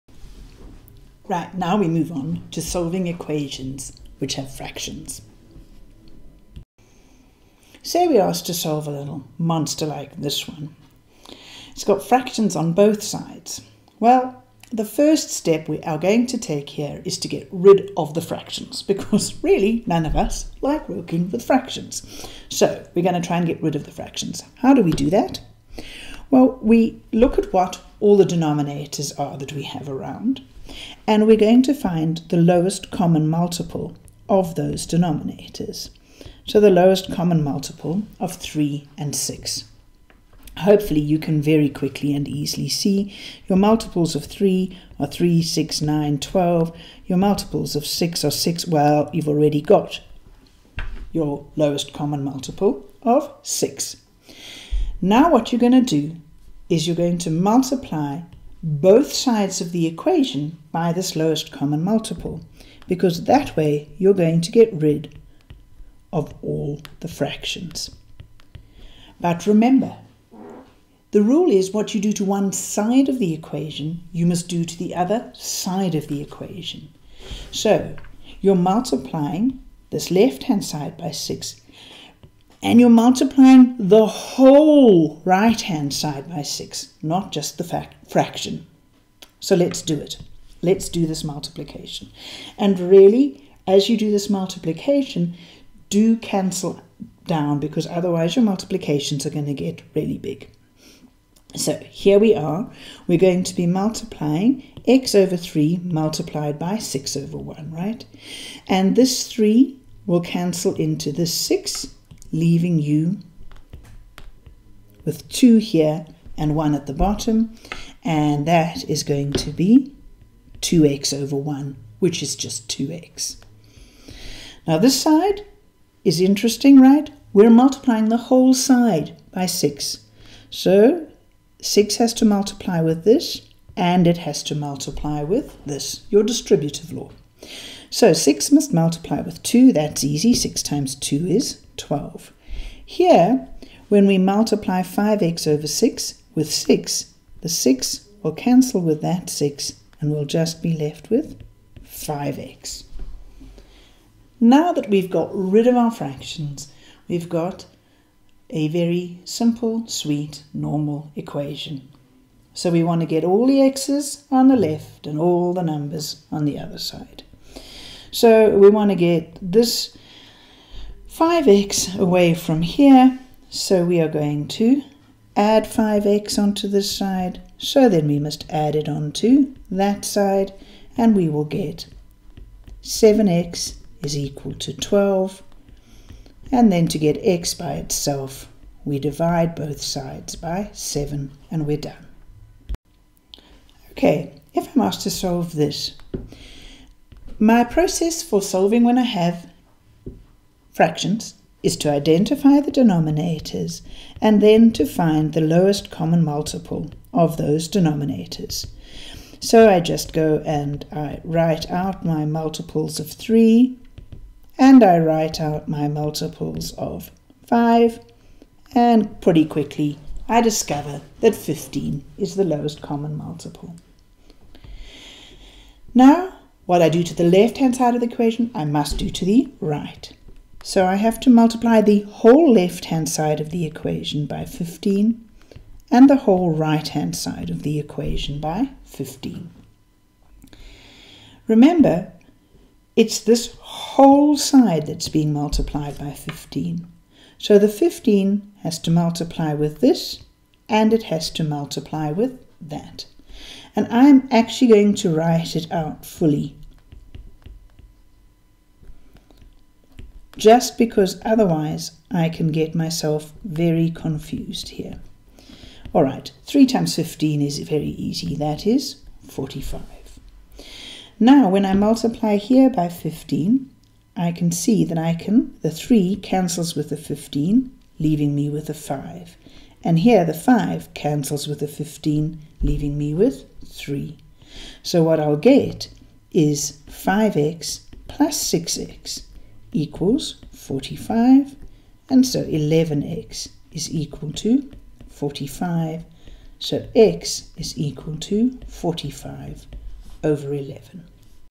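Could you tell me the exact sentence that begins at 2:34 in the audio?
Now that we've got rid of our fractions, we've got a very simple, sweet, normal equation.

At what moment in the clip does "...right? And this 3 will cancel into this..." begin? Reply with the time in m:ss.
1:47.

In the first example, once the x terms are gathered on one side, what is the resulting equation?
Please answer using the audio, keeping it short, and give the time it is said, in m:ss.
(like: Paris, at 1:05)
7x = 12, at 3:02.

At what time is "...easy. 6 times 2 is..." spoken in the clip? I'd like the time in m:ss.
2:20.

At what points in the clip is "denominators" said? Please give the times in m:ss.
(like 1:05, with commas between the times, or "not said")
0:28, 0:34, 3:22, 3:27.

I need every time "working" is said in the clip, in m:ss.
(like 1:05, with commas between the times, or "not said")
0:20.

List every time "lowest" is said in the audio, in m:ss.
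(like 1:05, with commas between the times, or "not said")
0:32, 0:36, 0:51, 1:01, 3:25, 3:42.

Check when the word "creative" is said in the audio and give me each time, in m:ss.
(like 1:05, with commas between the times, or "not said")
not said.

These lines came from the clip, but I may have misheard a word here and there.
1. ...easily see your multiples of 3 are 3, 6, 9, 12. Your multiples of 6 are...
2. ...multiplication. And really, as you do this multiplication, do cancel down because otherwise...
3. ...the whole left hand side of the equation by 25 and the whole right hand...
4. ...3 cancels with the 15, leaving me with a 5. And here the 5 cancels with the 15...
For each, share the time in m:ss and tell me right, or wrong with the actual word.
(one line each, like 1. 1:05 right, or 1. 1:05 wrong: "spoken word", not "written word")
1. 0:42 right
2. 1:31 right
3. 3:51 wrong: "15", not "25"
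4. 4:35 right.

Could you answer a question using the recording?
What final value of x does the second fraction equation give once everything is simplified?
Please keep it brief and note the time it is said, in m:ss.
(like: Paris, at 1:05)
45/11, at 4:58.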